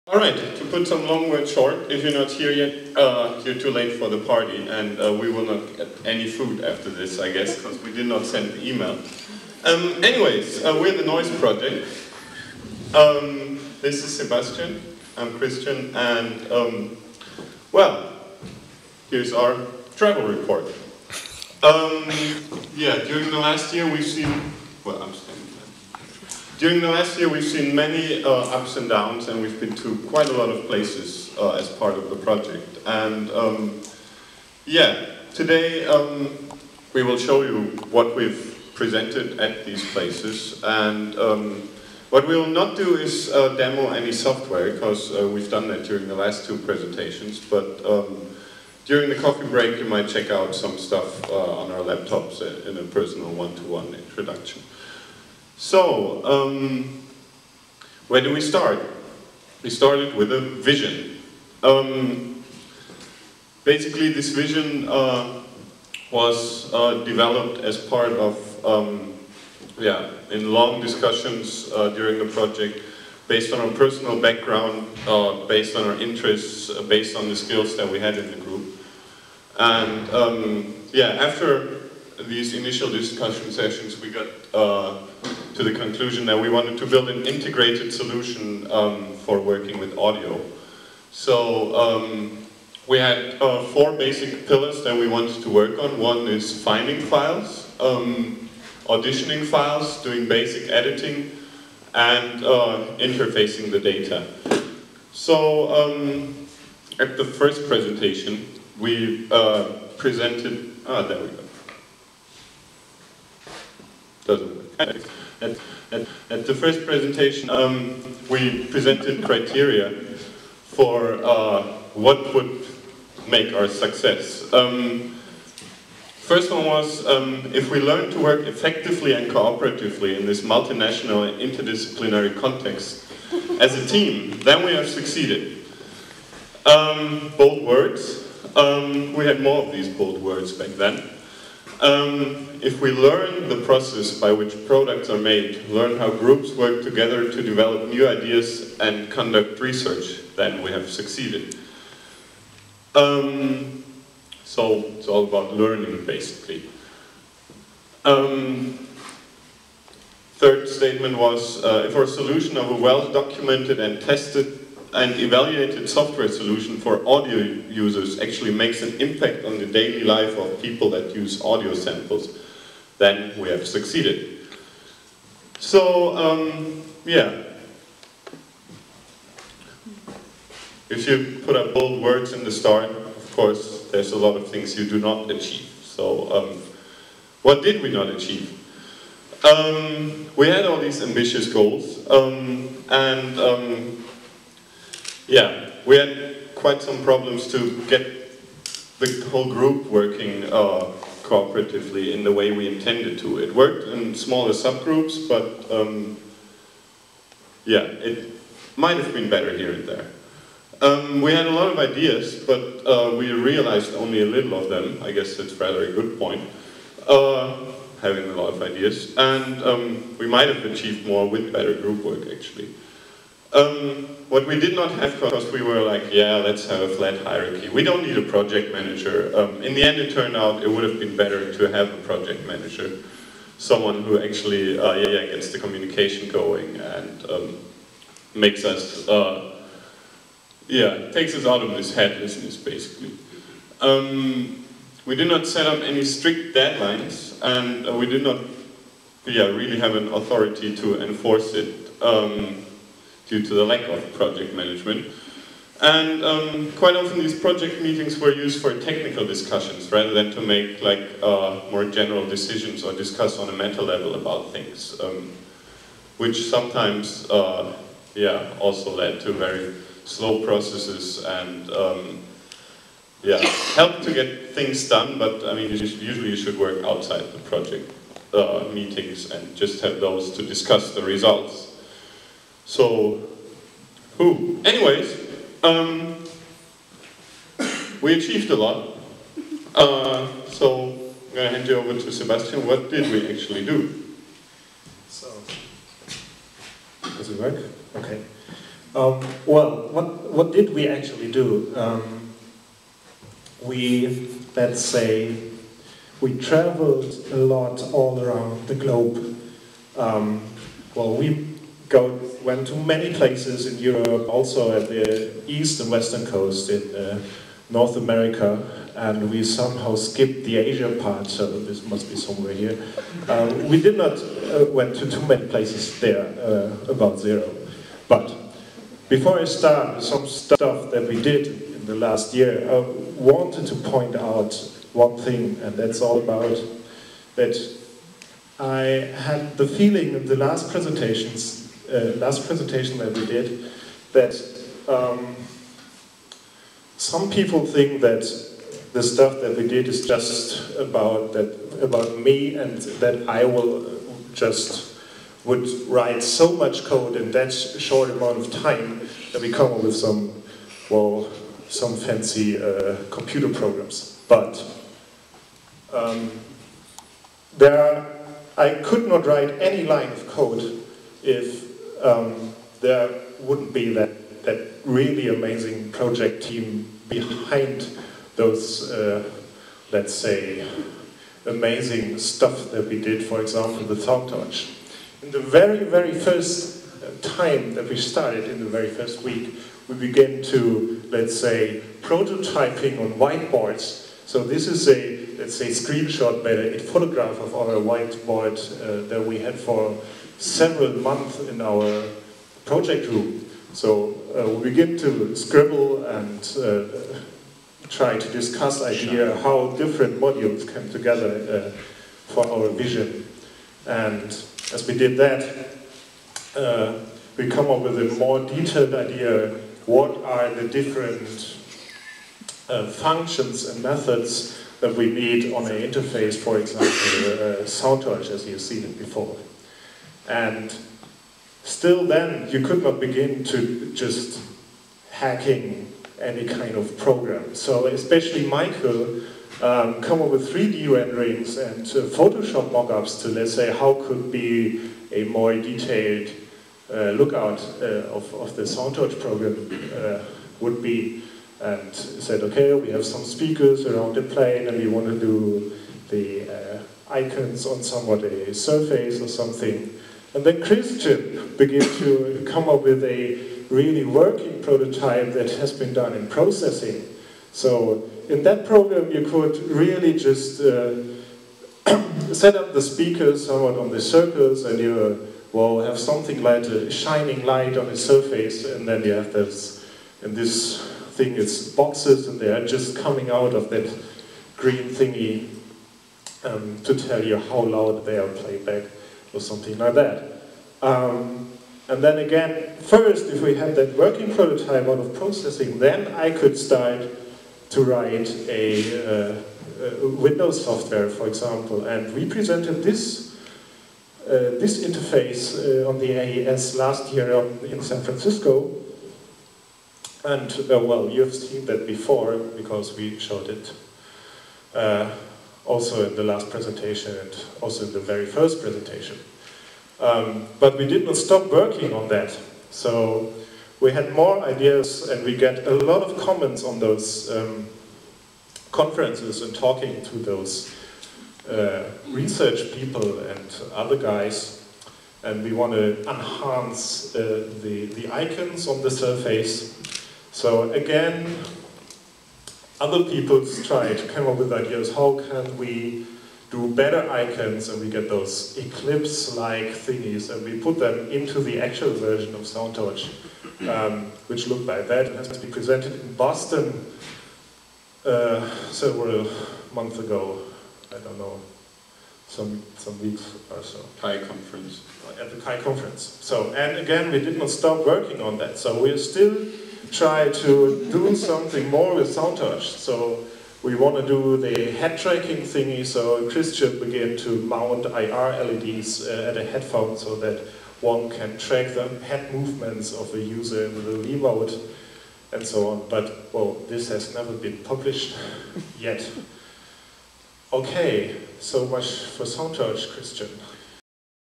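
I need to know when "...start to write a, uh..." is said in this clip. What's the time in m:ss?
8:16.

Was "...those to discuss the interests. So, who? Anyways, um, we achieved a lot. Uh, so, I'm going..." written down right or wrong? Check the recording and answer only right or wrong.
wrong.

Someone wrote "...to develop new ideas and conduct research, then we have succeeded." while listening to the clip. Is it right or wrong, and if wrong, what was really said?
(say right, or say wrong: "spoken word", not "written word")
right.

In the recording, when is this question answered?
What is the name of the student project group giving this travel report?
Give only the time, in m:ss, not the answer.
0:11.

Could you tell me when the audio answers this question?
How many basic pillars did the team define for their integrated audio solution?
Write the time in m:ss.
1:33.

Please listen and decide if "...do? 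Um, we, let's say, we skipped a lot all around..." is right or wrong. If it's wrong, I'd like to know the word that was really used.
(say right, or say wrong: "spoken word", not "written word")
wrong: "traveled", not "skipped".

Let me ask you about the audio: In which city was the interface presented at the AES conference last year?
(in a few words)
San Francisco.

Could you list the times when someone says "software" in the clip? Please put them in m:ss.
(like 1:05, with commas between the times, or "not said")
0:44, 2:45, 8:20.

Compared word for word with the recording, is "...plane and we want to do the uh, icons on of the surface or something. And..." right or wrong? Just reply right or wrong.
right.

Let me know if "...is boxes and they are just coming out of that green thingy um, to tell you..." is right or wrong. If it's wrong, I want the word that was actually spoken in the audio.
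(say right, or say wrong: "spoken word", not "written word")
right.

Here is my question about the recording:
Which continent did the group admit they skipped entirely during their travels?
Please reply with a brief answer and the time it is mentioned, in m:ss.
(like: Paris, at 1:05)
Asia, at 5:20.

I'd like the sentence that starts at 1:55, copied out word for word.
At, at, at the first presentation, um, we presented criteria for uh, what would make our success.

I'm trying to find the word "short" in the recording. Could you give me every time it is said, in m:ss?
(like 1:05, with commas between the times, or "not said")
0:01, 5:57.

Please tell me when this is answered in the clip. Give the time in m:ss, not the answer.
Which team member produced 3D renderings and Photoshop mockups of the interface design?
7:18.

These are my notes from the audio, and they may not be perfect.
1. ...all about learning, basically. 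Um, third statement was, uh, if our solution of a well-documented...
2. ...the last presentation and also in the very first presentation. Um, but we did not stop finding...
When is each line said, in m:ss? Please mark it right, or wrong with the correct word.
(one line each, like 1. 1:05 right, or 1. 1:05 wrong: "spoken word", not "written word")
1. 2:35 right
2. 8:36 wrong: "working", not "finding".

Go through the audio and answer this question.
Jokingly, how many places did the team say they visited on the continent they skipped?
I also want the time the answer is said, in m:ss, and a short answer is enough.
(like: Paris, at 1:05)
0, at 5:27.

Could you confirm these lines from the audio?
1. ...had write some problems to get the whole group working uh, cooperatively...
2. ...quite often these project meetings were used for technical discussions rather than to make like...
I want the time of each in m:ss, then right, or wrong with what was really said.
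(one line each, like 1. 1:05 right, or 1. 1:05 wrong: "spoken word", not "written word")
1. 3:15 wrong: "quite", not "write"
2. 4:16 right.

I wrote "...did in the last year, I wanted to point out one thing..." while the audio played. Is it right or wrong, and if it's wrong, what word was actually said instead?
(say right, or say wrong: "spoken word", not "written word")
right.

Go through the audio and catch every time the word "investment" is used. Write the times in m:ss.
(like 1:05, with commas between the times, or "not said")
not said.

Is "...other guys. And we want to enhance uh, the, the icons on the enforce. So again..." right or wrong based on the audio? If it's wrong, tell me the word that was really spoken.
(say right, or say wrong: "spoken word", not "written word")
wrong: "surface", not "enforce".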